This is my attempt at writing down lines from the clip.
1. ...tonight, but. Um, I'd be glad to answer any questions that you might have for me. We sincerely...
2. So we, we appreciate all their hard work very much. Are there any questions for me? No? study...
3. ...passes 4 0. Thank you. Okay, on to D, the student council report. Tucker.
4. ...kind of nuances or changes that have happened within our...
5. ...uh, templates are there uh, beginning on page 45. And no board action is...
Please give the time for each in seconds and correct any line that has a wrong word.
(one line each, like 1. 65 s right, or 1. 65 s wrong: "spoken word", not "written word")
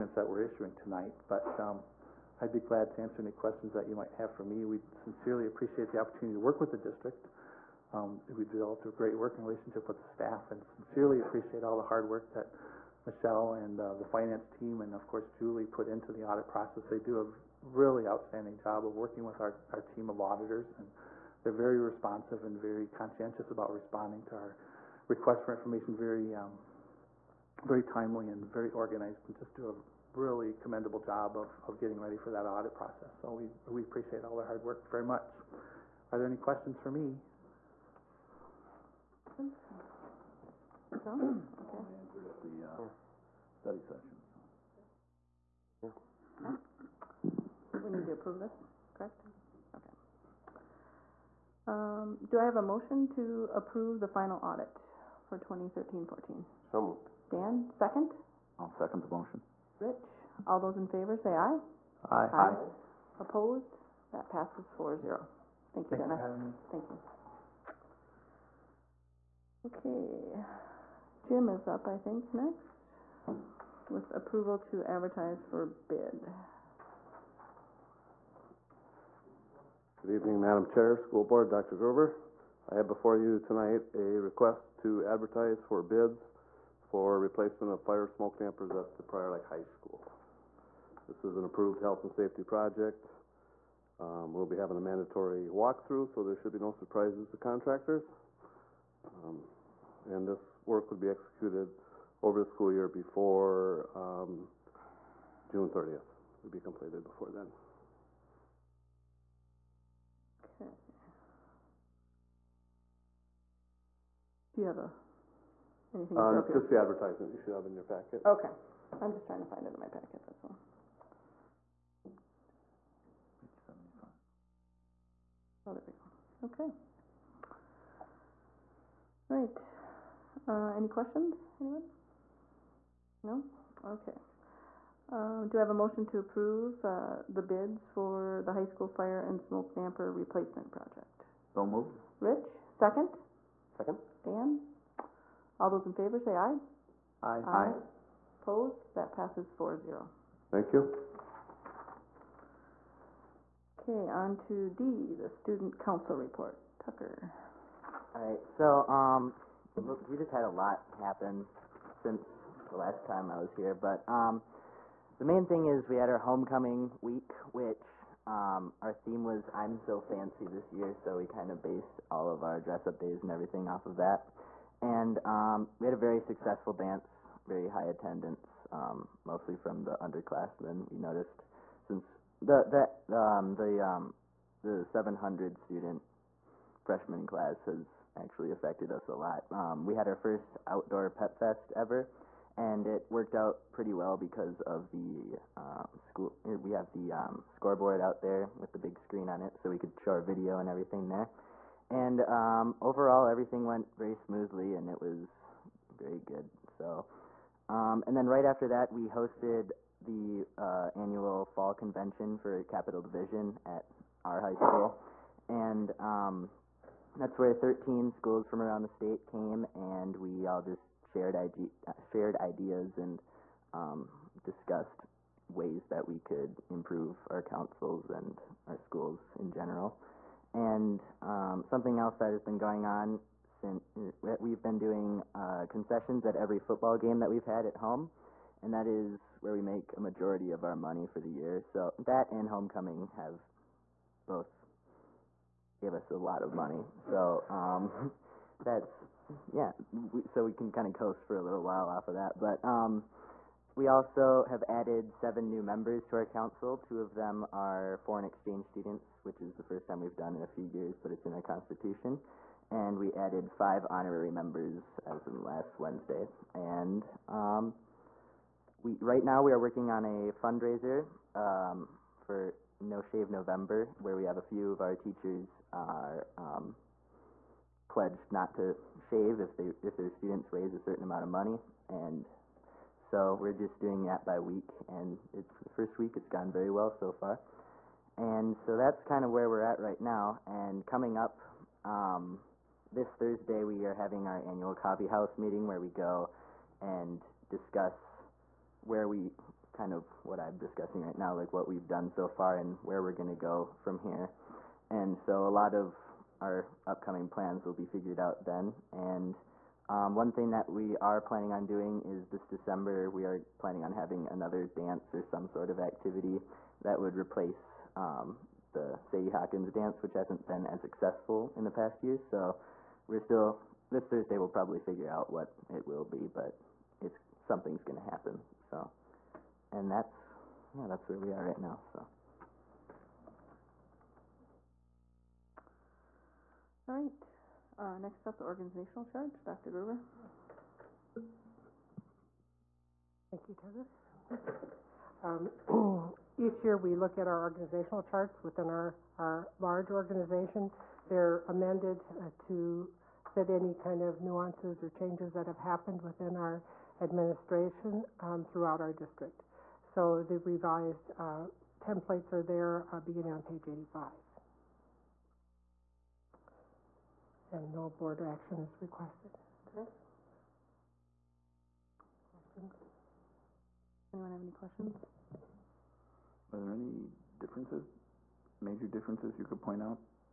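1. 0 s right
2. 33 s right
3. 149 s right
4. 353 s right
5. 361 s wrong: "85", not "45".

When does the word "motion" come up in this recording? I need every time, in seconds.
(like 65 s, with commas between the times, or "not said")
52 s, 59 s, 135 s.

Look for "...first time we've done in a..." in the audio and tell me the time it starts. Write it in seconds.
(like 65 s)
259 s.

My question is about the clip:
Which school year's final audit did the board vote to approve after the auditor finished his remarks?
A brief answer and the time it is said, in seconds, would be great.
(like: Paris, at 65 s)
2013-14, at 55 s.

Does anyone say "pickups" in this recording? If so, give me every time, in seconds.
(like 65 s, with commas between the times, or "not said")
not said.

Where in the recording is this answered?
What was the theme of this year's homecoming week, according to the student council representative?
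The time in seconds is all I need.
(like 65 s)
169 s.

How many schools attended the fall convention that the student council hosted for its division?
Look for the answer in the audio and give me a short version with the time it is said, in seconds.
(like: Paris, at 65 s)
13, at 217 s.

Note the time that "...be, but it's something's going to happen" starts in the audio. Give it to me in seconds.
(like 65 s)
326 s.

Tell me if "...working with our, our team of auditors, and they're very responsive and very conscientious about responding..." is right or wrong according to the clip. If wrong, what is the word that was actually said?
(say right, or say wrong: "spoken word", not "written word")
right.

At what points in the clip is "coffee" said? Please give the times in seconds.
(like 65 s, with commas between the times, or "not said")
294 s.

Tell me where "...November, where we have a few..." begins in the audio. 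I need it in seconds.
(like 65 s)
273 s.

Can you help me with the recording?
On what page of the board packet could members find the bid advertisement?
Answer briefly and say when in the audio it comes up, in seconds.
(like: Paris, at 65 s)
75, at 123 s.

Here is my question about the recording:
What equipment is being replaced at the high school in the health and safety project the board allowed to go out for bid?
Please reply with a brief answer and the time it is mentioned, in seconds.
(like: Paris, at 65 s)
Fire smoke dampers, at 87 s.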